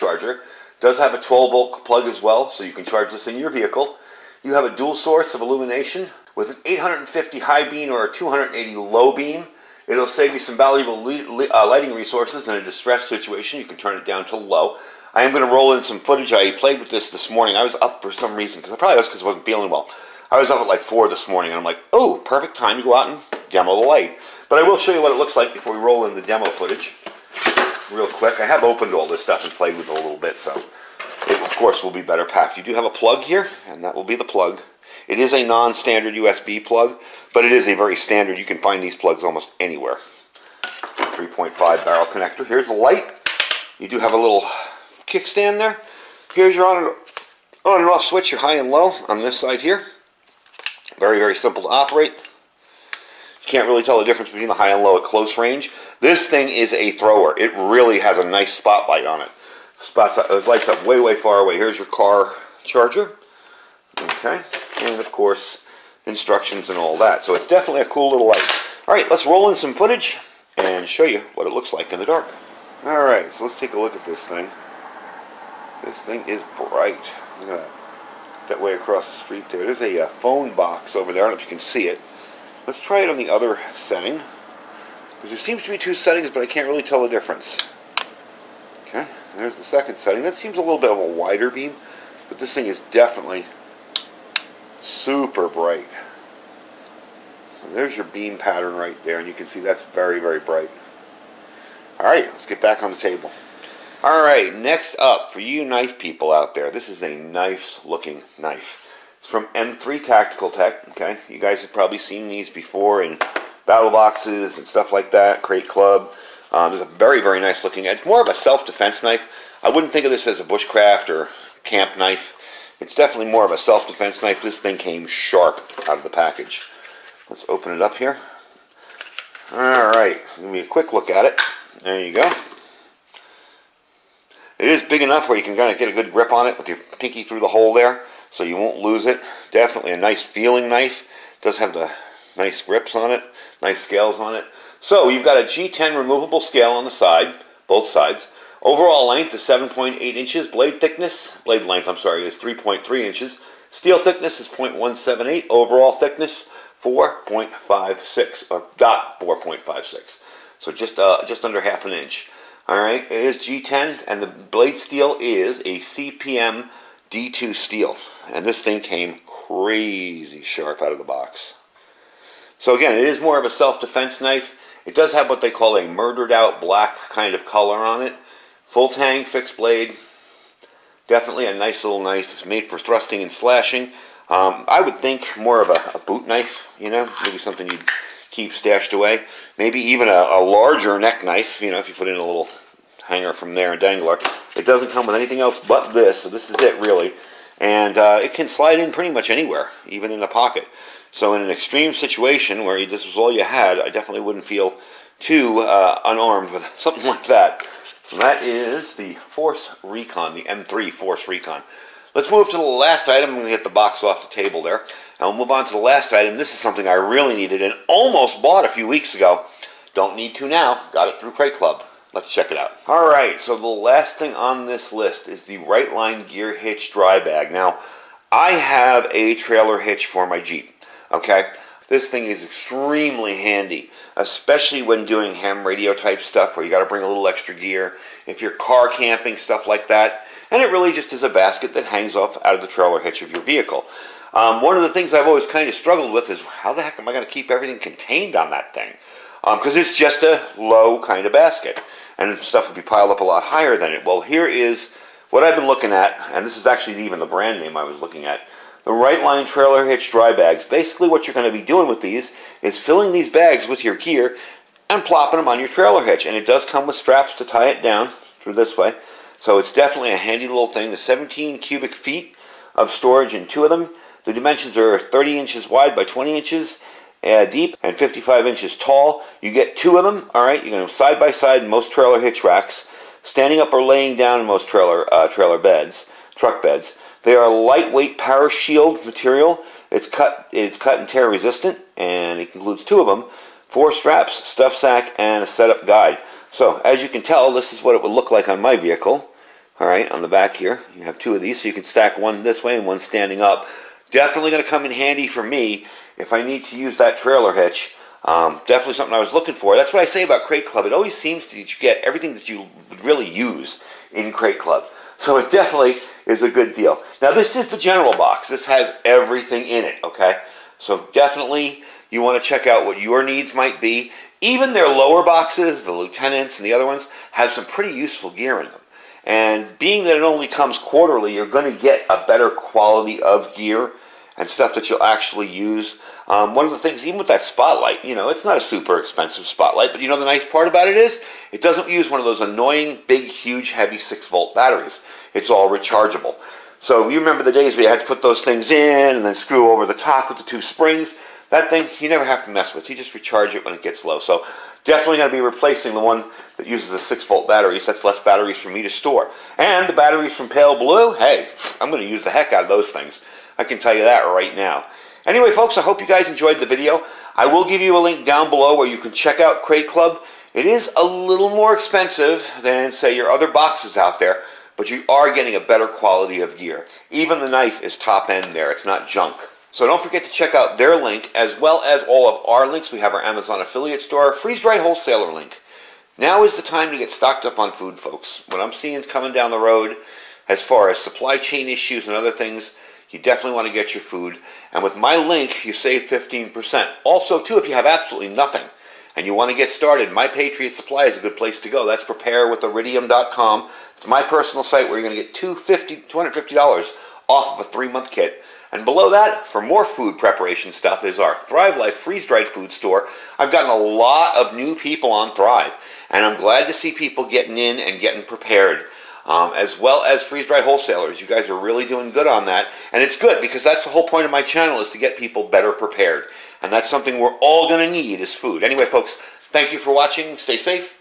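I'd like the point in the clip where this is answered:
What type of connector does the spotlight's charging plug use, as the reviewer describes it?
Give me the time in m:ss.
0:40.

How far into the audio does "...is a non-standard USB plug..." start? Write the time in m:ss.
0:35.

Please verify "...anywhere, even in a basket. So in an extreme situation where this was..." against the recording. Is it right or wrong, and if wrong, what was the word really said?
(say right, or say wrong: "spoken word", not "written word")
wrong: "pocket", not "basket".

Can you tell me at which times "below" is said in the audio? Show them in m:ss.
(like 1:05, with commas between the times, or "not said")
6:08, 6:48.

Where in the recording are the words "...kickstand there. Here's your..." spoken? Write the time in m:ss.
0:45.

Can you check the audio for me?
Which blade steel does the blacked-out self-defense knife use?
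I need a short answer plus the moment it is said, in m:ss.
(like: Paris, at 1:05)
CPM D2, at 2:45.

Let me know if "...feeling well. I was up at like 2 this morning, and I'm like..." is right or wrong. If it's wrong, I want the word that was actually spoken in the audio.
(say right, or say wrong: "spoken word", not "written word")
wrong: "4", not "2".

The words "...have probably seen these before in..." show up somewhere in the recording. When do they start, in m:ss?
1:51.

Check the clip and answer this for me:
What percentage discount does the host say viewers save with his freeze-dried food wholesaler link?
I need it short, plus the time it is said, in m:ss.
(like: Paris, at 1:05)
15%, at 6:36.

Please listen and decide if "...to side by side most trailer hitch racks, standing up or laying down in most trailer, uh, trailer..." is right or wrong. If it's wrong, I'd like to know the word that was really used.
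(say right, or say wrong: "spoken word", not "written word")
right.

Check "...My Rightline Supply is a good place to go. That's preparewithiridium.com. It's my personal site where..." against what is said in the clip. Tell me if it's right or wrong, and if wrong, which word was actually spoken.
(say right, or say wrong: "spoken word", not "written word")
wrong: "Patriot", not "Rightline".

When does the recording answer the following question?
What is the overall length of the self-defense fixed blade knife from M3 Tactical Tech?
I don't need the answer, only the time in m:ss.
2:29.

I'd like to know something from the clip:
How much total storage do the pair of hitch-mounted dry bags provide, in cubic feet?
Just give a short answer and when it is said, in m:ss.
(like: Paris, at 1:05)
17 cubic feet, at 4:30.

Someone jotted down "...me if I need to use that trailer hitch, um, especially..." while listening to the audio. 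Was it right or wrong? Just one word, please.
wrong.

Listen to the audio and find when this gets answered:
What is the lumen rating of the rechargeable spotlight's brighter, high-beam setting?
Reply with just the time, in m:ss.
0:06.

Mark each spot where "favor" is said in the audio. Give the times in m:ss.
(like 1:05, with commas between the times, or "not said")
not said.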